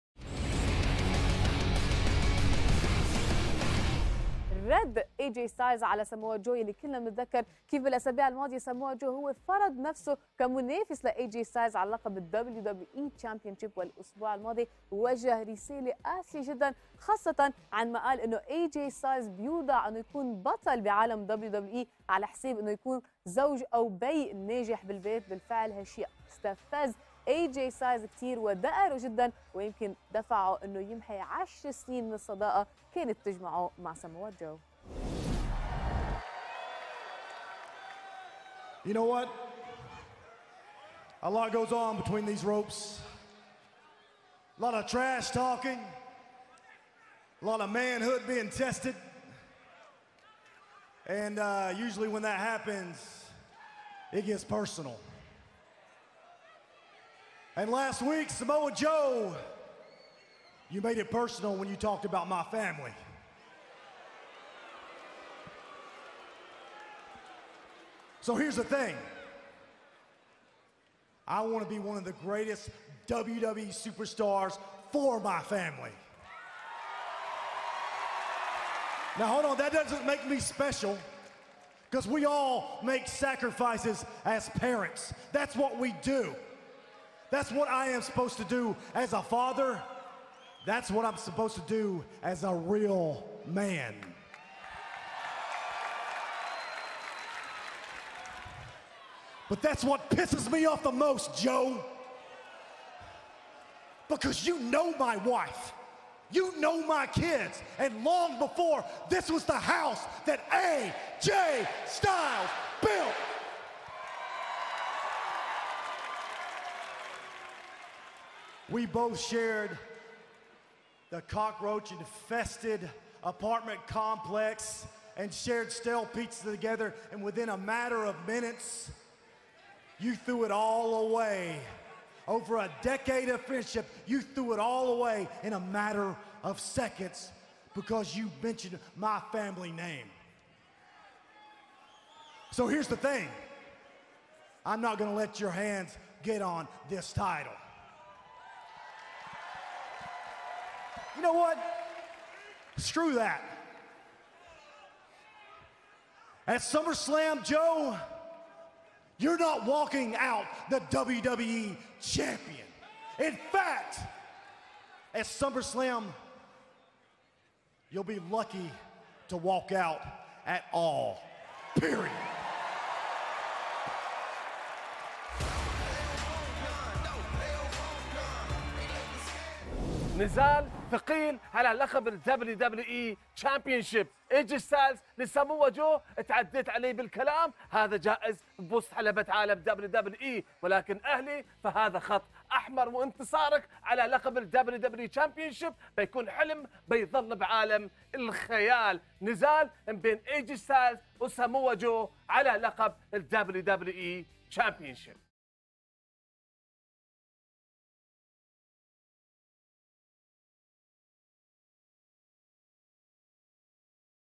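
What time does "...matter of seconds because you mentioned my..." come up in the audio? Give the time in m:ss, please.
2:15.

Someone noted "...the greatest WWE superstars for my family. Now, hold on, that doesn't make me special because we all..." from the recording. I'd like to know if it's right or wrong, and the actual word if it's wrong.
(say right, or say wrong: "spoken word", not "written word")
right.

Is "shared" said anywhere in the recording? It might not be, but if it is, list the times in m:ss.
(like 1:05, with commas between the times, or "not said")
1:59, 2:05.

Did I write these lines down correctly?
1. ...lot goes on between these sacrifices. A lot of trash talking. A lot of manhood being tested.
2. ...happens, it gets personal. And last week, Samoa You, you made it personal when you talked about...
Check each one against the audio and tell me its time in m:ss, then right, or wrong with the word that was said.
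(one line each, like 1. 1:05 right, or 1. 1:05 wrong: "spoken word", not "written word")
1. 0:41 wrong: "ropes", not "sacrifices"
2. 0:52 wrong: "Joe", not "You".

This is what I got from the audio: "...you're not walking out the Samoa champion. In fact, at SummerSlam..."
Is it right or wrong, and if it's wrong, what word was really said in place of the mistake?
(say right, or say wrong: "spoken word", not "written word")
wrong: "WWE", not "Samoa".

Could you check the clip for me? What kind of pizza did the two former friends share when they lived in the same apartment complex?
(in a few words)
stale pizza.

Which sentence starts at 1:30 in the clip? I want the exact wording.
That's what I'm supposed to do as a real man.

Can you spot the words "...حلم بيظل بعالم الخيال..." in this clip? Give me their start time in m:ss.
3:16.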